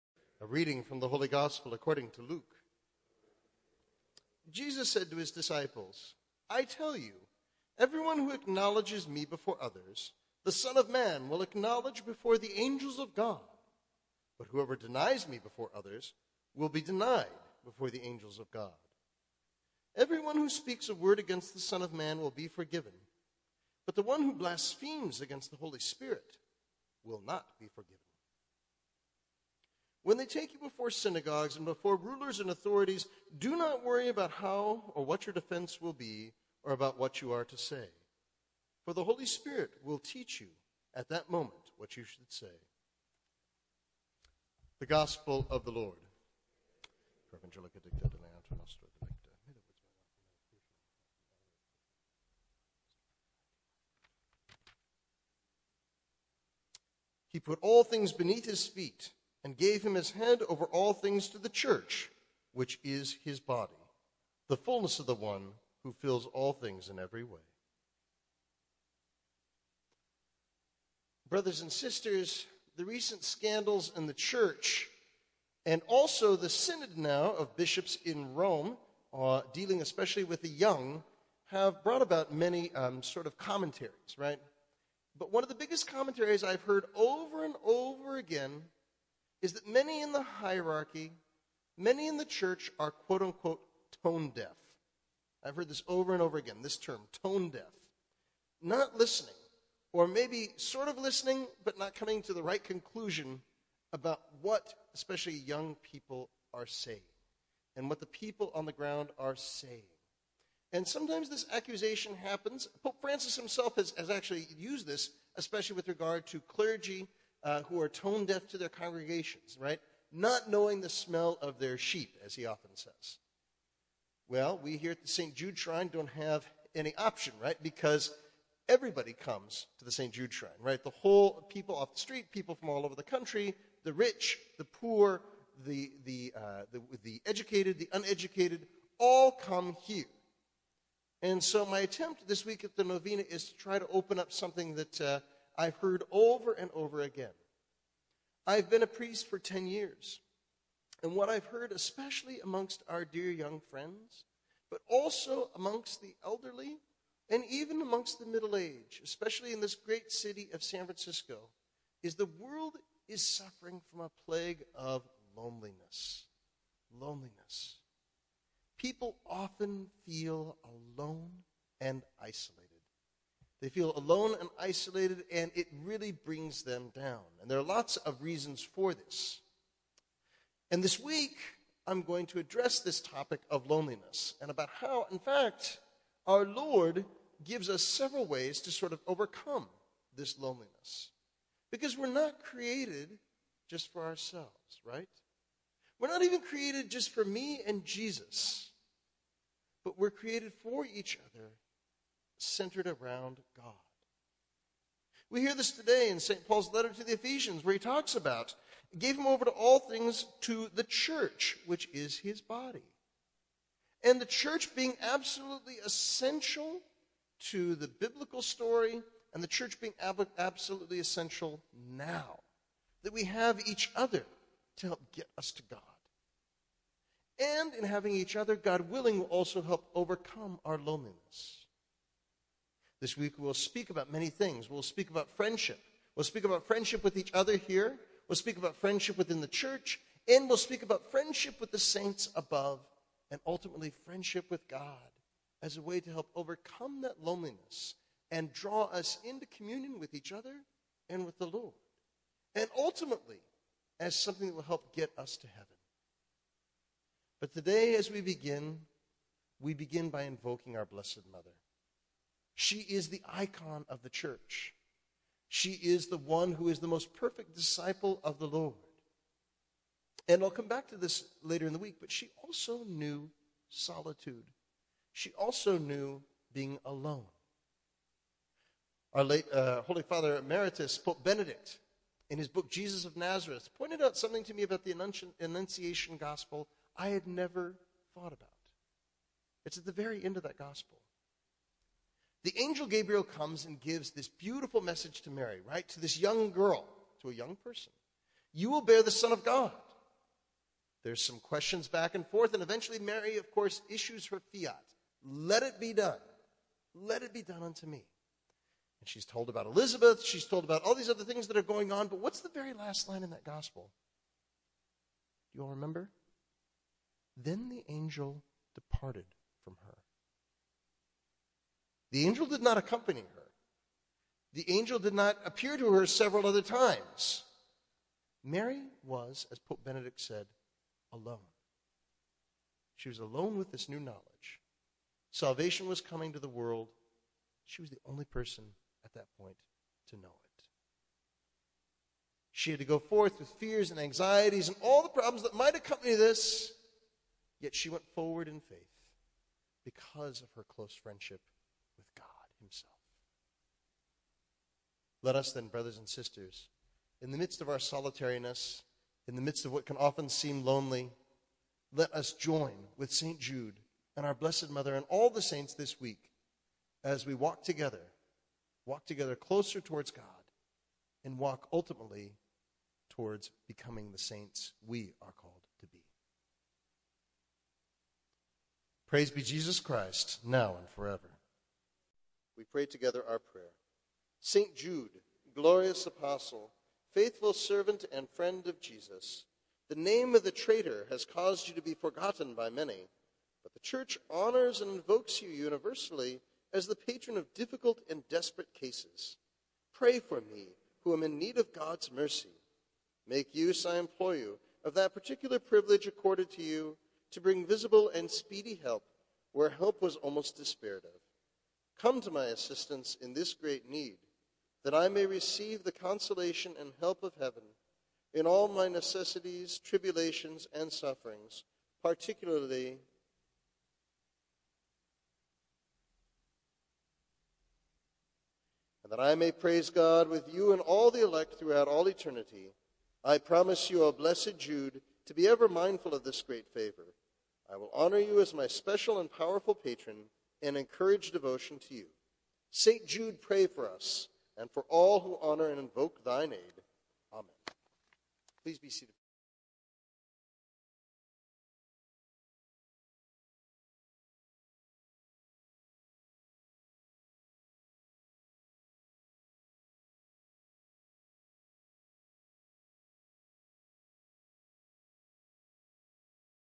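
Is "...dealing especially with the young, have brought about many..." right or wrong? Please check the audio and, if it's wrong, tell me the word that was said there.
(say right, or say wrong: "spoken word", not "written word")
right.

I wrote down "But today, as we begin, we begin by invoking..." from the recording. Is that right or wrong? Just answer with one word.
right.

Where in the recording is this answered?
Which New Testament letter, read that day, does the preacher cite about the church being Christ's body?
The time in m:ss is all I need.
3:27.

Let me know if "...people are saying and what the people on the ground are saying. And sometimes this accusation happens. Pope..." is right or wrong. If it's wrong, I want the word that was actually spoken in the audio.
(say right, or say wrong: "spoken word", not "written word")
right.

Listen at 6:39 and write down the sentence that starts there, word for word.
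Pray for me, who am in need of God's mercy.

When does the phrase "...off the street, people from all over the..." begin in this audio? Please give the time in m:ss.
2:11.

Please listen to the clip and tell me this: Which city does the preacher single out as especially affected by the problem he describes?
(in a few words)
San Francisco.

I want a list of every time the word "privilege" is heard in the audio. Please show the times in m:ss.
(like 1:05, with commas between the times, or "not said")
6:45.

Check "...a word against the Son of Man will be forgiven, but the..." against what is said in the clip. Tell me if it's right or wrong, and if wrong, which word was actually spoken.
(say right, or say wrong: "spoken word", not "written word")
right.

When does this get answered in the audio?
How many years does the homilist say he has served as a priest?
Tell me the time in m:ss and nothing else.
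2:29.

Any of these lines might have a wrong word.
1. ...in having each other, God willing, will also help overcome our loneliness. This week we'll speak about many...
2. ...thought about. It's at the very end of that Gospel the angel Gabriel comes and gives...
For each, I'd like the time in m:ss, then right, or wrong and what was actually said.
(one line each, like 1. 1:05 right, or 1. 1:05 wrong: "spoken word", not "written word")
1. 3:47 right
2. 4:48 right.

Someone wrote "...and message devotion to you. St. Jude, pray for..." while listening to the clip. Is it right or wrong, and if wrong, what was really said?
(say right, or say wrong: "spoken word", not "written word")
wrong: "encourage", not "message".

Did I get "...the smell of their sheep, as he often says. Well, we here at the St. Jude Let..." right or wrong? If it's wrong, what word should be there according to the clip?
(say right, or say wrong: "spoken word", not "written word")
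wrong: "Shrine", not "Let".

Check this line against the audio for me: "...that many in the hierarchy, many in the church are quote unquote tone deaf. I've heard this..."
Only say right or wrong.
right.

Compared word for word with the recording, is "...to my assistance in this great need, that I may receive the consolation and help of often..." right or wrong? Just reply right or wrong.
wrong.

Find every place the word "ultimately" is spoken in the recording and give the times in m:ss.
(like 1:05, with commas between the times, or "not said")
4:03, 4:12, 6:11.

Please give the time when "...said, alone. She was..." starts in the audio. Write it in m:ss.
5:30.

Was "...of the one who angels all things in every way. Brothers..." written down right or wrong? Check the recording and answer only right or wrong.
wrong.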